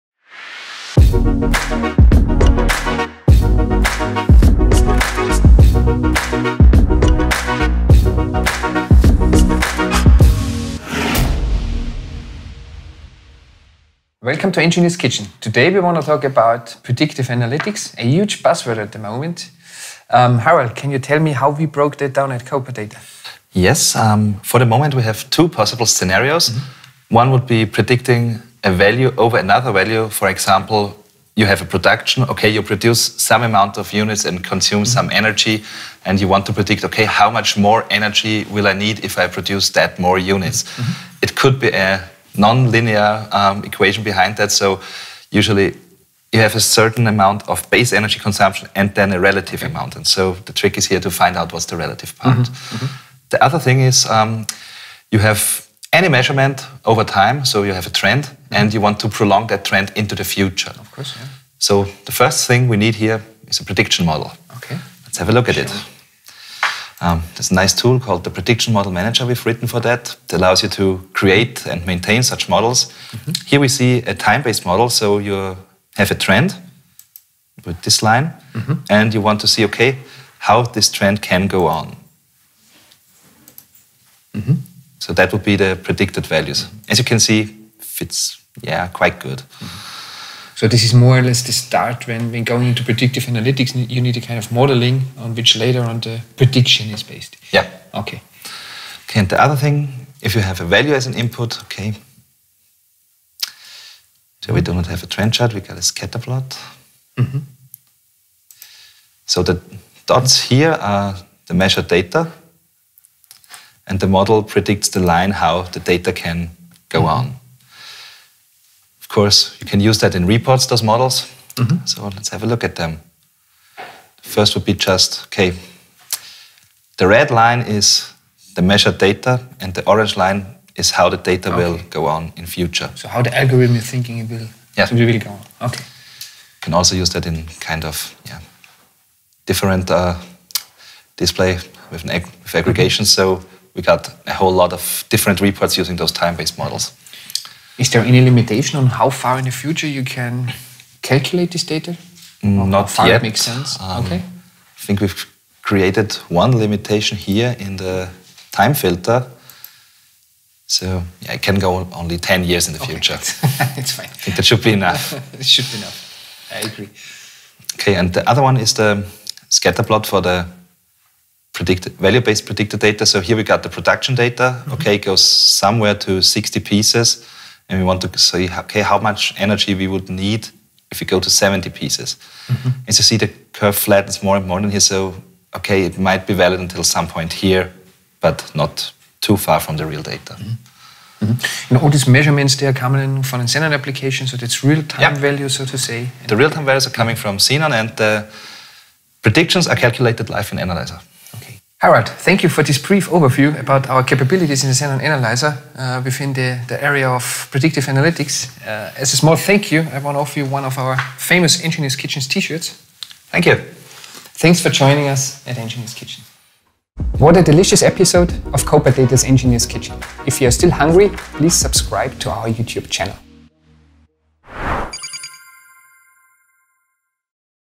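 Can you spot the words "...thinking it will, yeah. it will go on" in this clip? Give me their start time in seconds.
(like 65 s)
133 s.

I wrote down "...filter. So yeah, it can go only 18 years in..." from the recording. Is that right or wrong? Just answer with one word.
wrong.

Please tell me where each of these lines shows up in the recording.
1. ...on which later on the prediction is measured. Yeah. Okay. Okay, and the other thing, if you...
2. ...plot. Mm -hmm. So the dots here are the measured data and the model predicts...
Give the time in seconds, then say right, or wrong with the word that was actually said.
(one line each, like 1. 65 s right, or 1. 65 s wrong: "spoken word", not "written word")
1. 95 s wrong: "based", not "measured"
2. 106 s right.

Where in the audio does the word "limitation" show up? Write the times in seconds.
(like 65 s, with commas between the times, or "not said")
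148 s, 156 s.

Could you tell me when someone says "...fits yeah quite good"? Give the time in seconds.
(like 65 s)
87 s.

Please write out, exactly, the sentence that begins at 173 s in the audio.
So here we got the production data.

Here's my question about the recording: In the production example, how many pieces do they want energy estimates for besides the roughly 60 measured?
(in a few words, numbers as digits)
70.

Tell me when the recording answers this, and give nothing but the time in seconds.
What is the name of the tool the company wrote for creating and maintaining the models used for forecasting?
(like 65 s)
68 s.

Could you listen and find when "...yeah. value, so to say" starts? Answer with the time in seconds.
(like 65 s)
195 s.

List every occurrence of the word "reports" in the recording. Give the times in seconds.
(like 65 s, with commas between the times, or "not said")
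120 s, 145 s.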